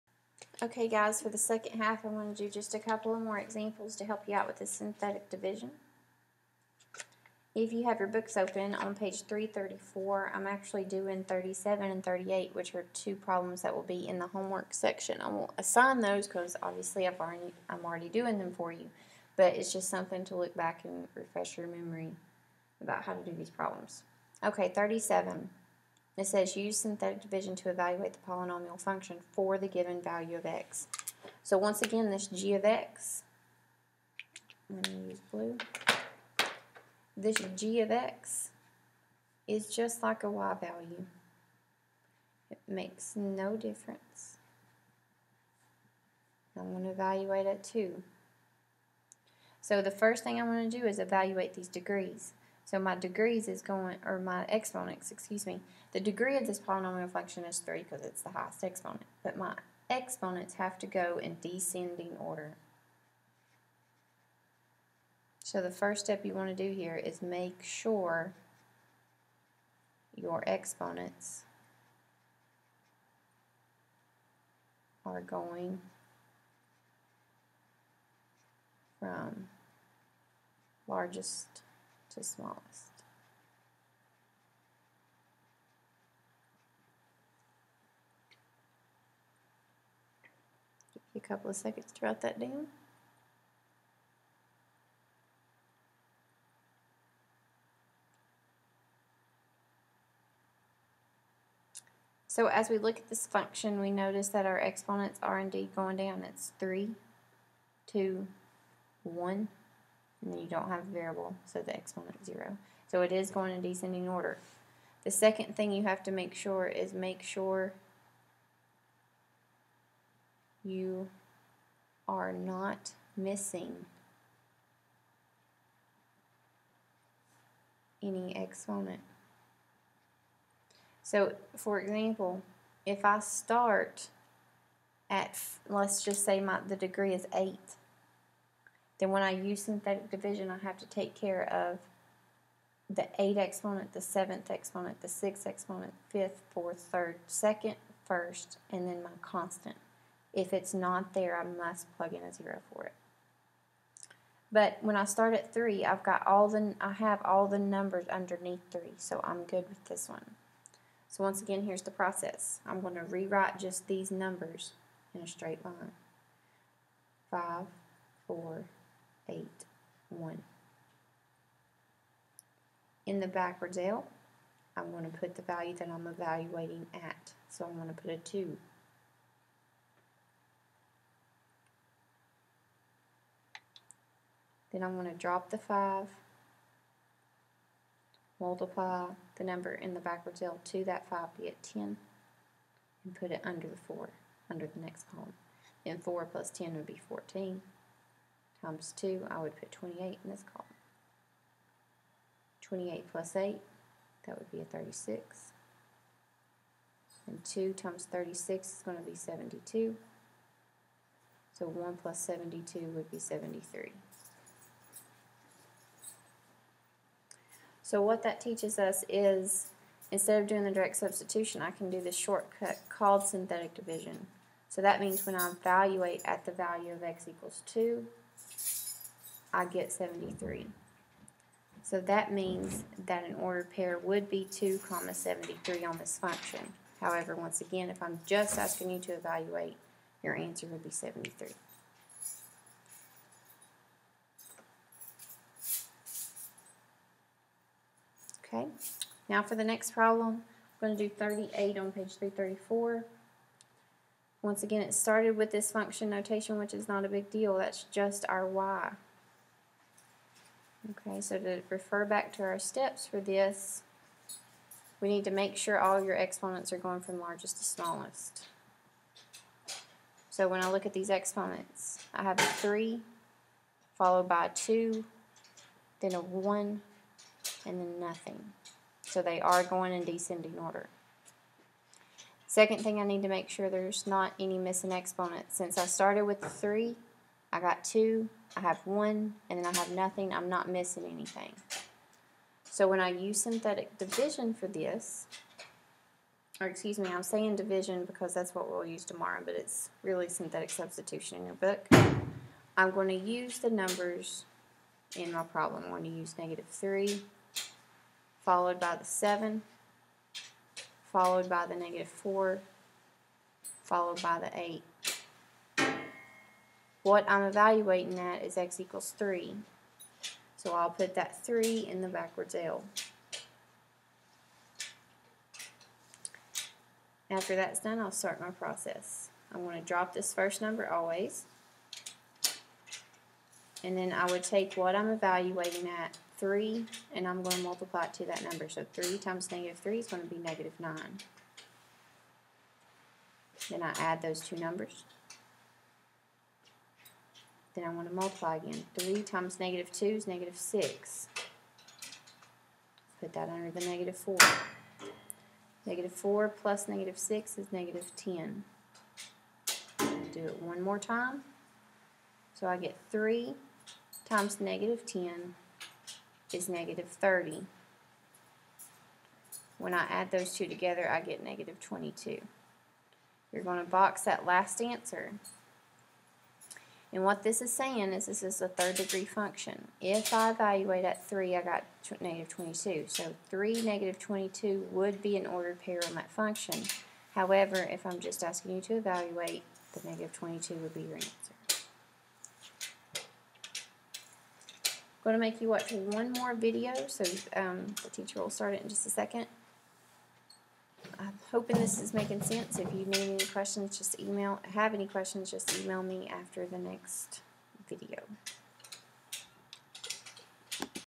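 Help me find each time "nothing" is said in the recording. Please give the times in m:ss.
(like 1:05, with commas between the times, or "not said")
4:37, 4:49.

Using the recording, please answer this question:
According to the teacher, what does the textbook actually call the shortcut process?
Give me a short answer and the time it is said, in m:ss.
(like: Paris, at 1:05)
synthetic substitution, at 5:00.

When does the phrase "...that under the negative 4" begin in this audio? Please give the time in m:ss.
5:53.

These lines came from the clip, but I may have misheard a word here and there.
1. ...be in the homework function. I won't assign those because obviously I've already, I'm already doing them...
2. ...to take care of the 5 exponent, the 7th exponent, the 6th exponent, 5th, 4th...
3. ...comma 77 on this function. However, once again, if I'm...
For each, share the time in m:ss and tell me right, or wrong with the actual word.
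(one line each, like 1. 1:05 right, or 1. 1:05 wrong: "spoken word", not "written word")
1. 0:13 wrong: "section", not "function"
2. 2:20 wrong: "8", not "5"
3. 3:54 wrong: "73", not "77".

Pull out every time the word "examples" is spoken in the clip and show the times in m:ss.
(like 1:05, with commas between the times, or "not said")
0:03, 2:11.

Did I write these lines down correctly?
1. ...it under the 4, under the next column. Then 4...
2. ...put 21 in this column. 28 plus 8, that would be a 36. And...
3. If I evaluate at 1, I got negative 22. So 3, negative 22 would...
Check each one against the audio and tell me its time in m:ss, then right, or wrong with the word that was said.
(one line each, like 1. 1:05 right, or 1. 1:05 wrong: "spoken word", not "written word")
1. 3:13 right
2. 3:19 wrong: "28", not "21"
3. 6:19 wrong: "3", not "1".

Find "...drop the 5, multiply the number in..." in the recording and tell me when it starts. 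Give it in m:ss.
3:05.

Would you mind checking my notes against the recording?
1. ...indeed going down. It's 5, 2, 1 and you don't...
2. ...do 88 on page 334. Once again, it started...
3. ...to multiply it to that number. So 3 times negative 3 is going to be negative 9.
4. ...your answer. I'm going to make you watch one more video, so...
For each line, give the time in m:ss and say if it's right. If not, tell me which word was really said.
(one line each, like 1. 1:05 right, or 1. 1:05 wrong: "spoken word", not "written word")
1. 1:45 wrong: "3", not "5"
2. 4:11 wrong: "38", not "88"
3. 5:37 right
4. 6:31 right.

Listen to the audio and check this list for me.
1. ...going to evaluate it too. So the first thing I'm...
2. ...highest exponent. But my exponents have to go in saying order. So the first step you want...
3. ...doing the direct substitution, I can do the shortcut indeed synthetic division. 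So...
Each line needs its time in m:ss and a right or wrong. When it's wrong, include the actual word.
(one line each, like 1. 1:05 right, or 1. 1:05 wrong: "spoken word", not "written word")
1. 0:46 right
2. 0:58 wrong: "descending", not "saying"
3. 3:40 wrong: "called", not "indeed".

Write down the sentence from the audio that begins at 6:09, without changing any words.
When I add those two together, I get negative 22.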